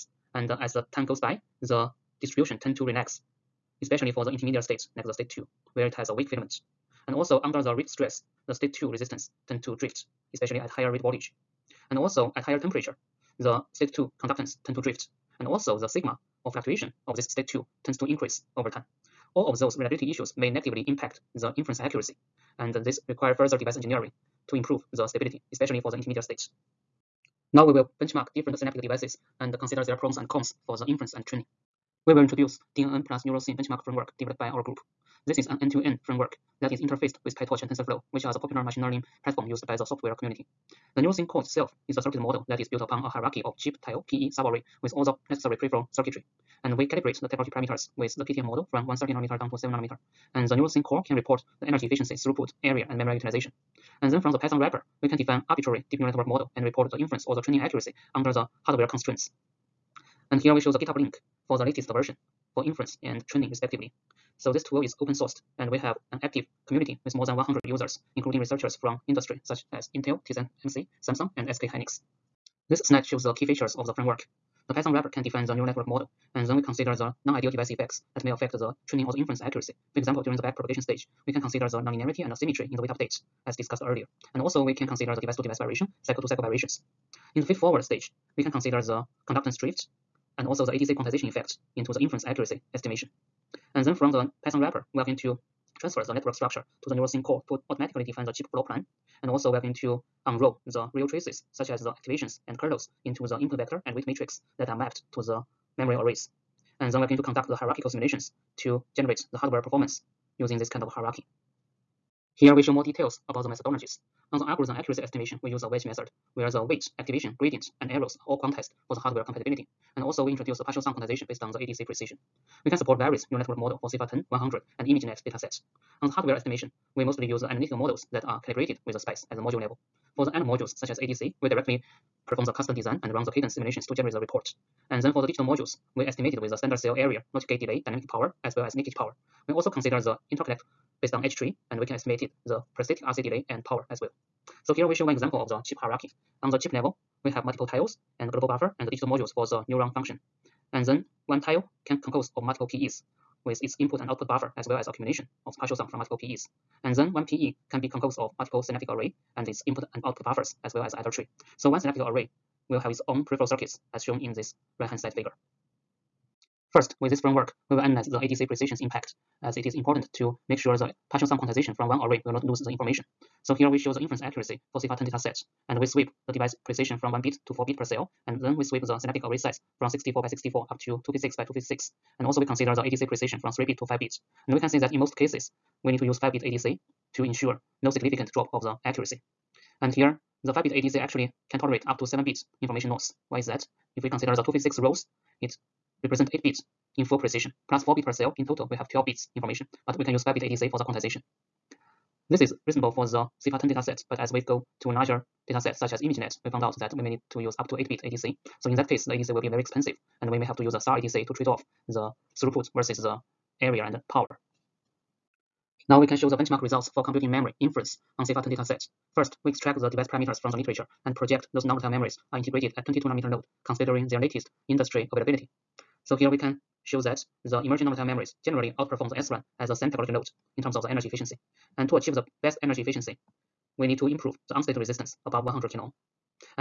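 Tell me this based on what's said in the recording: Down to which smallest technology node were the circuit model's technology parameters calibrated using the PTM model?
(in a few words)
7 nanometer.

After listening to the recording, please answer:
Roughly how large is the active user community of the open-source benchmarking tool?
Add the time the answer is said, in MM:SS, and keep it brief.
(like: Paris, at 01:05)
more than 100, at 01:07.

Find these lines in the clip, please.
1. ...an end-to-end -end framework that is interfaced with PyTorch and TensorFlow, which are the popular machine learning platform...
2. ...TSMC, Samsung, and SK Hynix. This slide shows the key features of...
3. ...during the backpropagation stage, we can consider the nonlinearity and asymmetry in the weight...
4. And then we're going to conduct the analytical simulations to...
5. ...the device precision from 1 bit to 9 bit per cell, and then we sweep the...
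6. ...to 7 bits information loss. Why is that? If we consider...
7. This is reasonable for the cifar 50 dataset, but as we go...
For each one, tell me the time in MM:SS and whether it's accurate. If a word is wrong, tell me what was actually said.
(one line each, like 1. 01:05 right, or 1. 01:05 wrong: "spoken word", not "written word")
1. 00:35 right
2. 01:10 right
3. 01:20 right
4. 01:46 wrong: "hierarchical", not "analytical"
5. 02:56 wrong: "4", not "9"
6. 03:11 right
7. 03:22 wrong: "10", not "50".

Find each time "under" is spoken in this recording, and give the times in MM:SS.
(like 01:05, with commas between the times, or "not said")
00:07, 00:58.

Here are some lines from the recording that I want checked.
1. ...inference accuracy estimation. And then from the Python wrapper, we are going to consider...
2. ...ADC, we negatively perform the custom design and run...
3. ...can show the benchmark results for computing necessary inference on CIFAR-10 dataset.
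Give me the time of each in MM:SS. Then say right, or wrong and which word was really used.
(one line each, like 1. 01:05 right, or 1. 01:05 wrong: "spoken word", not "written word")
1. 01:31 wrong: "transfer", not "consider"
2. 02:10 wrong: "directly", not "negatively"
3. 03:36 wrong: "memory", not "necessary".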